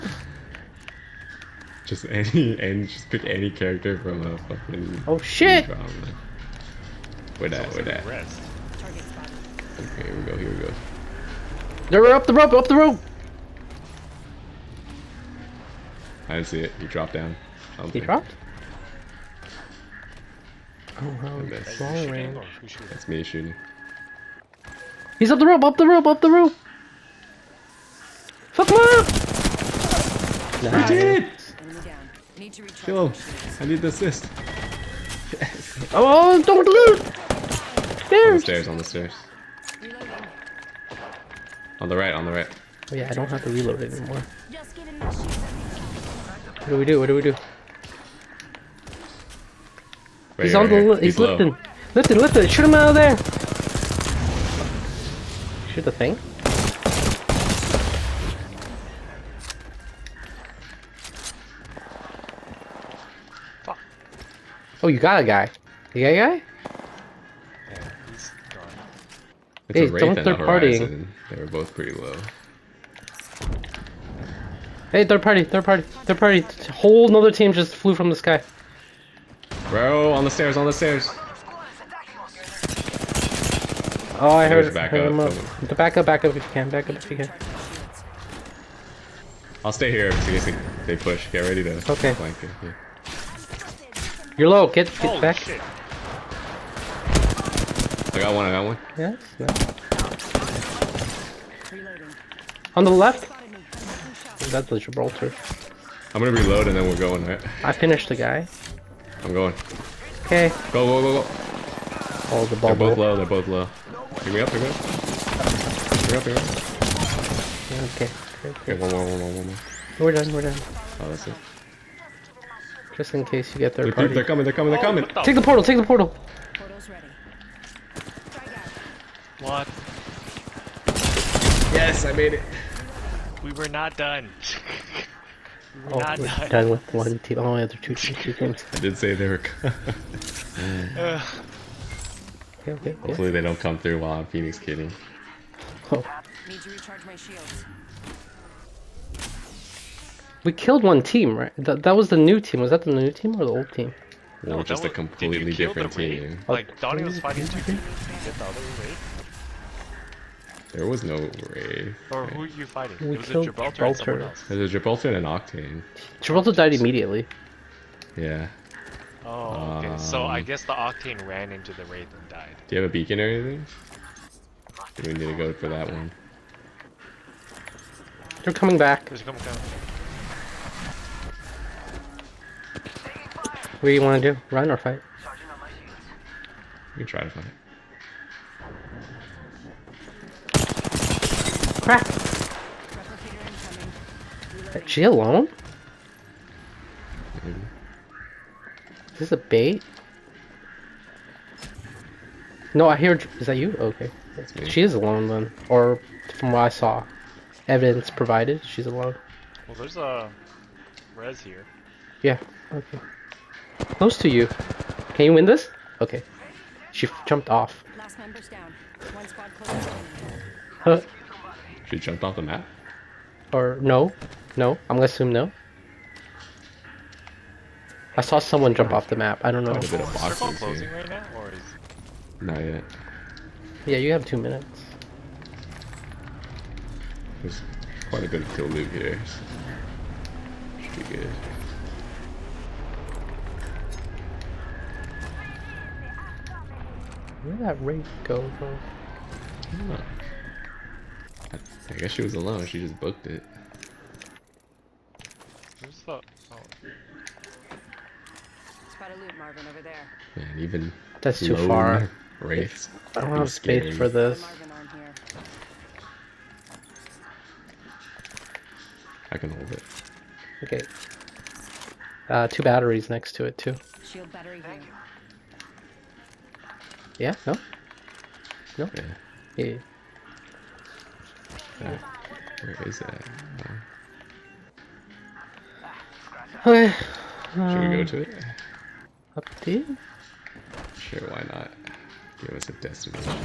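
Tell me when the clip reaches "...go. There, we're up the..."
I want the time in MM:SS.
00:10.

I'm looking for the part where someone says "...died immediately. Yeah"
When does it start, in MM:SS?
02:46.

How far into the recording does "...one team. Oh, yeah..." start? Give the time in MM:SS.
02:16.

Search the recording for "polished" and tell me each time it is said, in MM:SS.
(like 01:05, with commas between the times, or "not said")
not said.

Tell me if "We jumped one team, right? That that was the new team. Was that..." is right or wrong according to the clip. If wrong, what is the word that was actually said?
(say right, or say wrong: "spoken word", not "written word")
wrong: "killed", not "jumped".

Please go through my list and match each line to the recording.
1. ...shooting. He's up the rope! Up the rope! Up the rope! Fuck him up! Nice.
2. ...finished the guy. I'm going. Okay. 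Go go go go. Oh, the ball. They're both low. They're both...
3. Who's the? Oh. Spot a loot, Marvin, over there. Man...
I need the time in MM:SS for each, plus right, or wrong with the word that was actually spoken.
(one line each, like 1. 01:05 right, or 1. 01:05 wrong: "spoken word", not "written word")
1. 00:23 right
2. 01:47 right
3. 04:15 right.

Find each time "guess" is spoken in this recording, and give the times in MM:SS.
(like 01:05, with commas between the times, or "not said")
02:50, 04:11.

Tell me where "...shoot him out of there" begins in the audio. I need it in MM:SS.
00:52.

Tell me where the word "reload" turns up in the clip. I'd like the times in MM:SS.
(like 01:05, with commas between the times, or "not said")
00:43, 01:46.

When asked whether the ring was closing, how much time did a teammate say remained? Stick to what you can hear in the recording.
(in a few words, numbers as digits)
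2 minutes.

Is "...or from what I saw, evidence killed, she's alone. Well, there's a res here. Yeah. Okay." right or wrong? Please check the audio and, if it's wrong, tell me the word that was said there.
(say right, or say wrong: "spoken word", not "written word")
wrong: "provided", not "killed".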